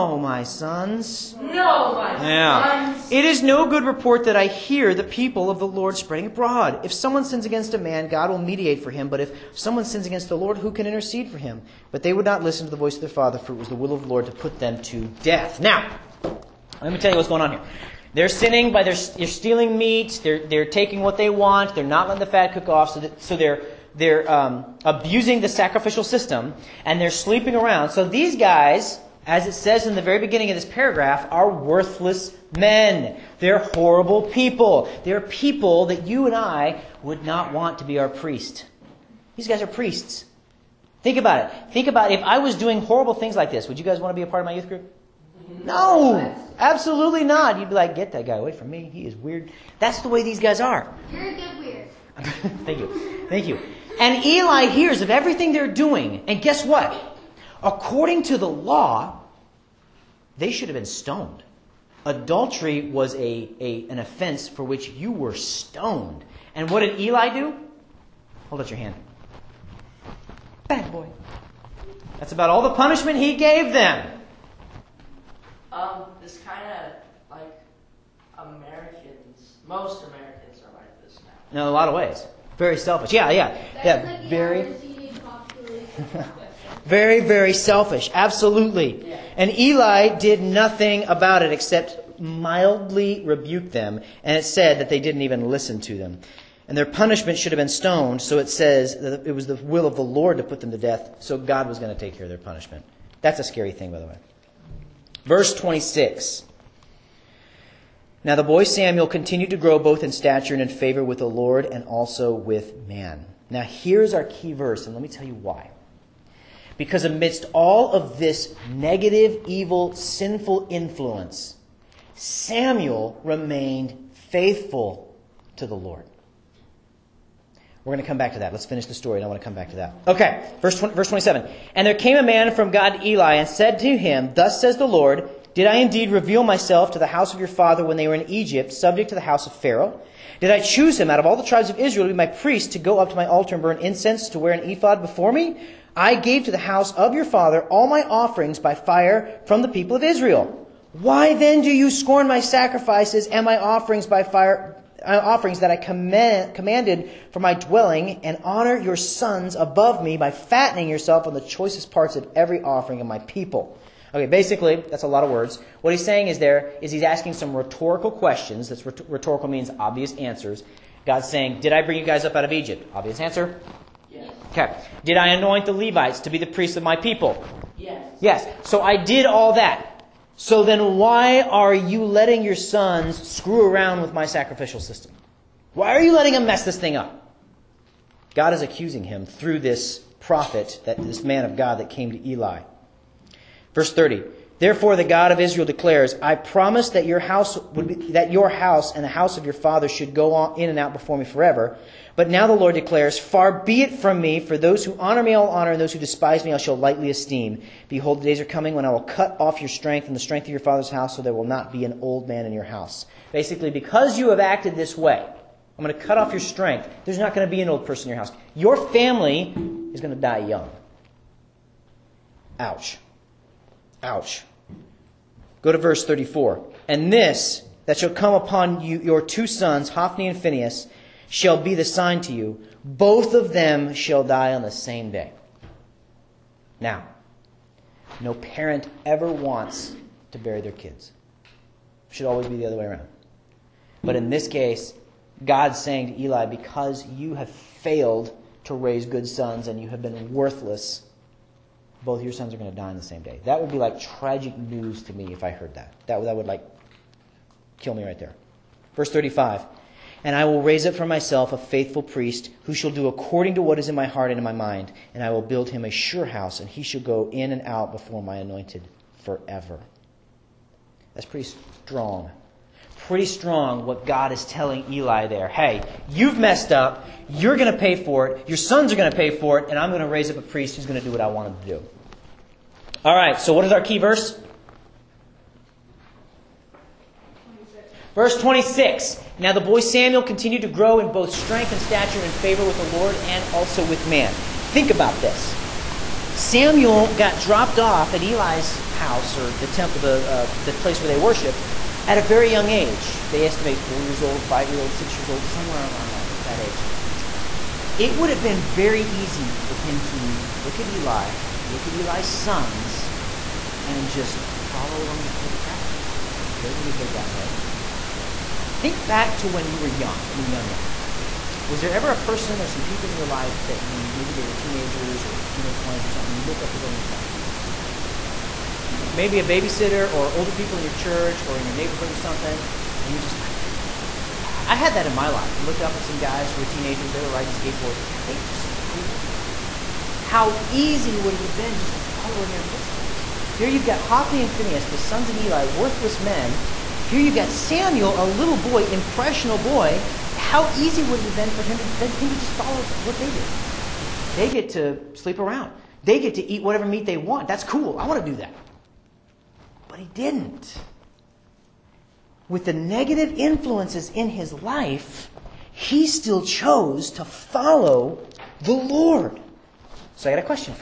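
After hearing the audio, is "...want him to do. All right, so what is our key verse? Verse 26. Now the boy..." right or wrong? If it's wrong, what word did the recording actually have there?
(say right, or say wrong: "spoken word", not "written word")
right.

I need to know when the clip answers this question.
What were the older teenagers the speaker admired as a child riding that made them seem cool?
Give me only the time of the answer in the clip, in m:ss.
5:37.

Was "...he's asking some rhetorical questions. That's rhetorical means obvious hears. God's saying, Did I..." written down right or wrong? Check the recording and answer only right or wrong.
wrong.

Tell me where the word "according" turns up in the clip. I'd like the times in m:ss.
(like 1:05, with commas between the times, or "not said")
0:57, 4:23.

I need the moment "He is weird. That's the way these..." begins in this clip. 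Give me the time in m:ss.
0:48.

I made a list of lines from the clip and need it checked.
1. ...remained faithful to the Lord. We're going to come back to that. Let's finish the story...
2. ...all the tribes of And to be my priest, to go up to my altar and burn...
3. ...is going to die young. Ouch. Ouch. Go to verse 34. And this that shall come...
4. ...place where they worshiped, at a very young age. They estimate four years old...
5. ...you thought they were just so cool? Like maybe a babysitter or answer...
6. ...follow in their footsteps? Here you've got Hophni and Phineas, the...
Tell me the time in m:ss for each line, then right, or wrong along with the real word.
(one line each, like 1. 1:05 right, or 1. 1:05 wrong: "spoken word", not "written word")
1. 2:03 right
2. 2:21 wrong: "Israel", not "And"
3. 3:39 right
4. 5:00 right
5. 5:27 wrong: "older", not "answer"
6. 5:41 right.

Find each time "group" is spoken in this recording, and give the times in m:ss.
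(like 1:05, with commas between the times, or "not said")
0:44.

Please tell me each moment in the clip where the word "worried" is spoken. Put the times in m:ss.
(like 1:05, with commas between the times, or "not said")
not said.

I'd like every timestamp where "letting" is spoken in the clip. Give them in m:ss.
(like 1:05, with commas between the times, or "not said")
0:22, 3:02, 3:06.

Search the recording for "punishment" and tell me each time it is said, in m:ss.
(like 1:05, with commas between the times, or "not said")
1:12, 1:36, 1:42.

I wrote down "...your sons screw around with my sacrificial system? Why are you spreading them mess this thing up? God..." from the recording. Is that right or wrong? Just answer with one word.
wrong.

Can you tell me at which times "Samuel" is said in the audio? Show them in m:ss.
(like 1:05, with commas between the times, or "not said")
1:48, 2:02, 4:49, 4:56, 5:47.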